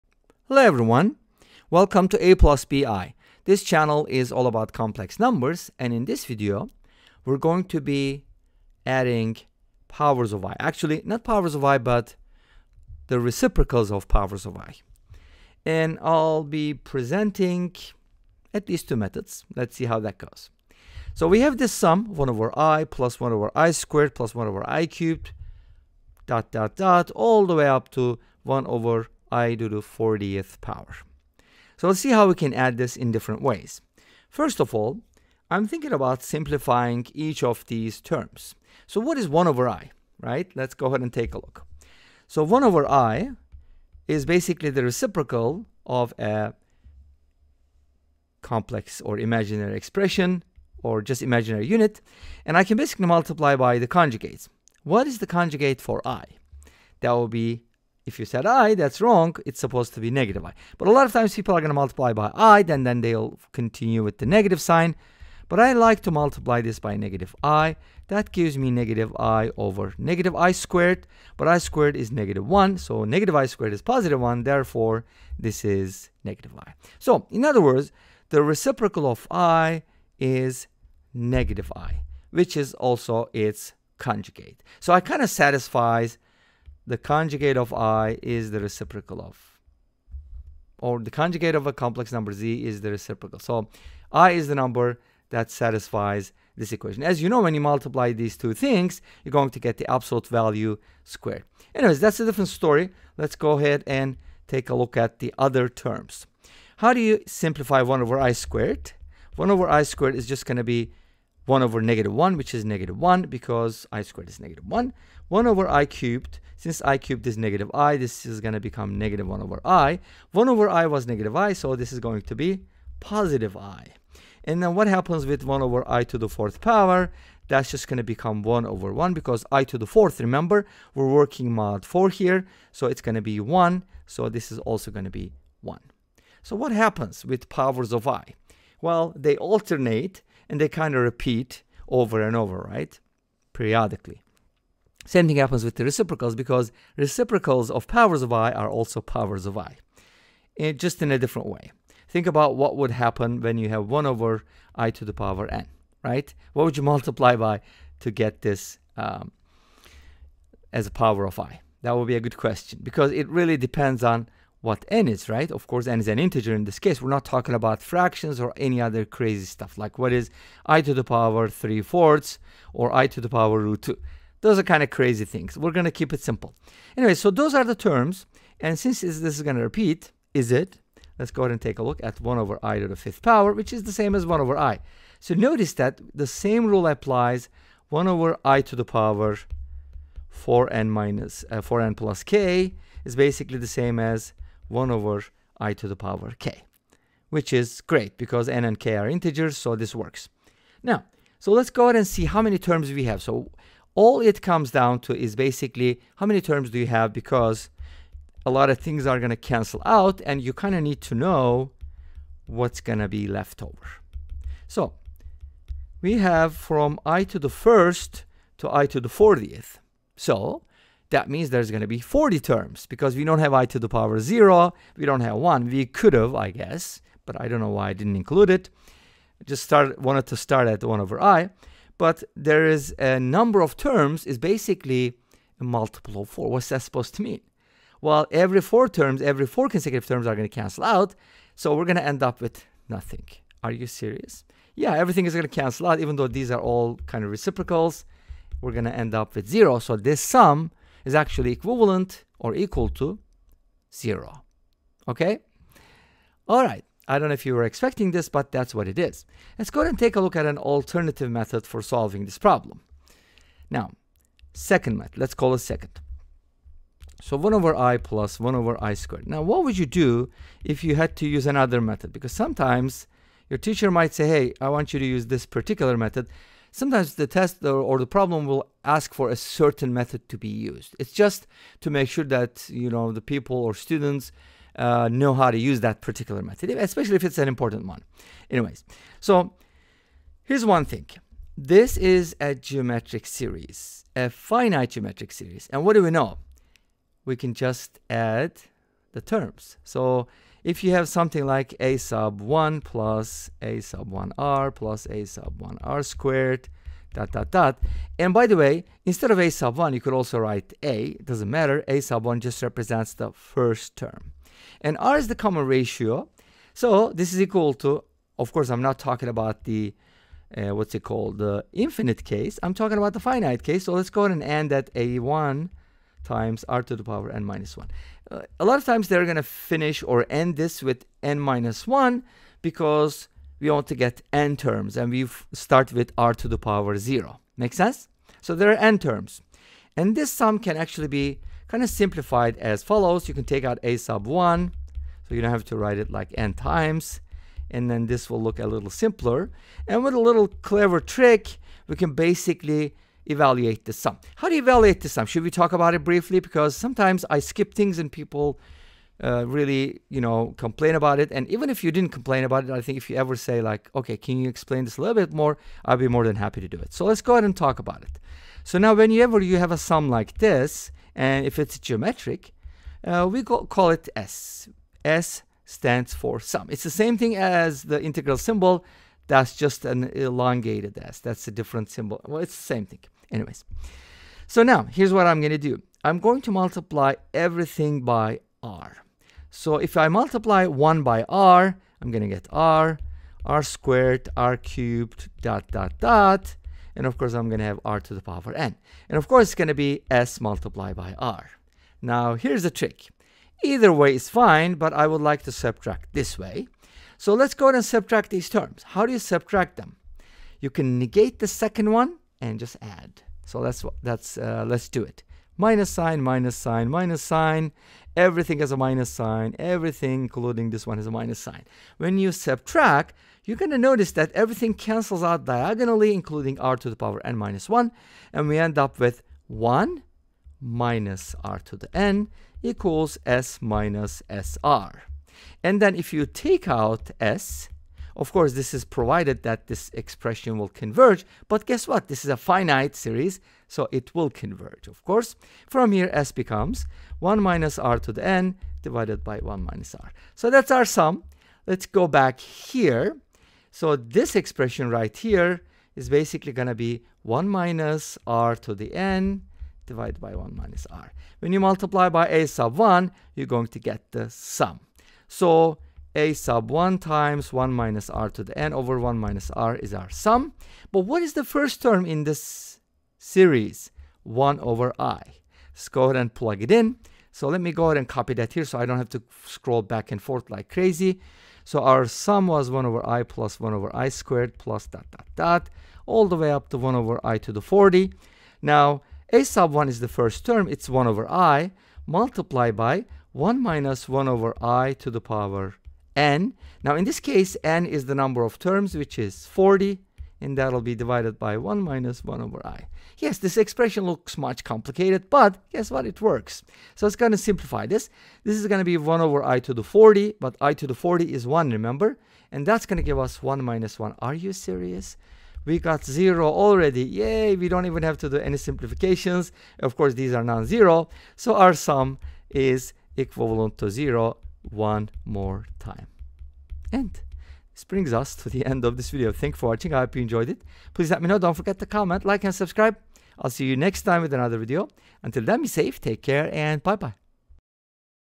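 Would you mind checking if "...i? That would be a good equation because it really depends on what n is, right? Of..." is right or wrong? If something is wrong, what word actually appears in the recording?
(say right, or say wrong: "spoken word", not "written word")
wrong: "question", not "equation".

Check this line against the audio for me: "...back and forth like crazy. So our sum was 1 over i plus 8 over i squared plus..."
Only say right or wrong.
wrong.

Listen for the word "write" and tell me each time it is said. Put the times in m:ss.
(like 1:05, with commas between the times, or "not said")
5:10, 5:45.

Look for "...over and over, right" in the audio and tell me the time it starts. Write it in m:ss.
2:21.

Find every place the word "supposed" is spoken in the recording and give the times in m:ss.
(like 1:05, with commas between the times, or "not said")
0:59, 3:56.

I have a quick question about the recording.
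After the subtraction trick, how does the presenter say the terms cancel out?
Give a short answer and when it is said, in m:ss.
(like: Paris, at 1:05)
diagonally, at 7:04.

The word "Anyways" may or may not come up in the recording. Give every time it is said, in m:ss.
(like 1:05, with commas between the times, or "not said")
1:41, 2:56, 4:48, 6:23.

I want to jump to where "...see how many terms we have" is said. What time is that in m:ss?
3:22.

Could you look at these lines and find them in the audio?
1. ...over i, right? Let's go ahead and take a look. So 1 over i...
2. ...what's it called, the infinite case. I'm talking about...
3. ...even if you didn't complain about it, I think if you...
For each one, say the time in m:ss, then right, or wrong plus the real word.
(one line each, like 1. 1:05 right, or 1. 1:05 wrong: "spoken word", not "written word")
1. 0:39 right
2. 5:20 right
3. 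6:01 right.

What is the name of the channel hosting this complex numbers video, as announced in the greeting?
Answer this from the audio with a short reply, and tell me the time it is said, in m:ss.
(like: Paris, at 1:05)
A plus BI, at 0:02.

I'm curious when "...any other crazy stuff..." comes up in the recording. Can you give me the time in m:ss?
2:48.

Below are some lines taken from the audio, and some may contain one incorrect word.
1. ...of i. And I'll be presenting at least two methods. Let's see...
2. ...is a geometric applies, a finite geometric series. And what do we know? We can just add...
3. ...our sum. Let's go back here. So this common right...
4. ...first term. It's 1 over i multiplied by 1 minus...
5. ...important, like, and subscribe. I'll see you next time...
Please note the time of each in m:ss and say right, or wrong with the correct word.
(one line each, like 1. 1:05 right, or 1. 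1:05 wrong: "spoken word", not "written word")
1. 0:14 right
2. 4:51 wrong: "series", not "applies"
3. 7:30 wrong: "expression", not "common"
4. 8:10 right
5. 8:51 wrong: "comment", not "important".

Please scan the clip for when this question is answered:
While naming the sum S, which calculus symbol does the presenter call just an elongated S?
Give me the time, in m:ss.
6:17.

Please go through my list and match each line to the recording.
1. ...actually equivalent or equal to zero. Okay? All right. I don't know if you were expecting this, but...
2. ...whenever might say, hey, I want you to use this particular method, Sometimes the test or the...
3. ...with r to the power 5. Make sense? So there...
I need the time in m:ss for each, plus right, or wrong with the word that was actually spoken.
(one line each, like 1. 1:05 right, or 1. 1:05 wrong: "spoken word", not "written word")
1. 4:11 right
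2. 4:33 wrong: "teacher", not "whenever"
3. 5:35 wrong: "0", not "5".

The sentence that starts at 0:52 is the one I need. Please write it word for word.
And I can basically multiply by the conjugates.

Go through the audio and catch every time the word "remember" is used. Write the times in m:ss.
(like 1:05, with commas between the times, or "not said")
2:10, 8:31.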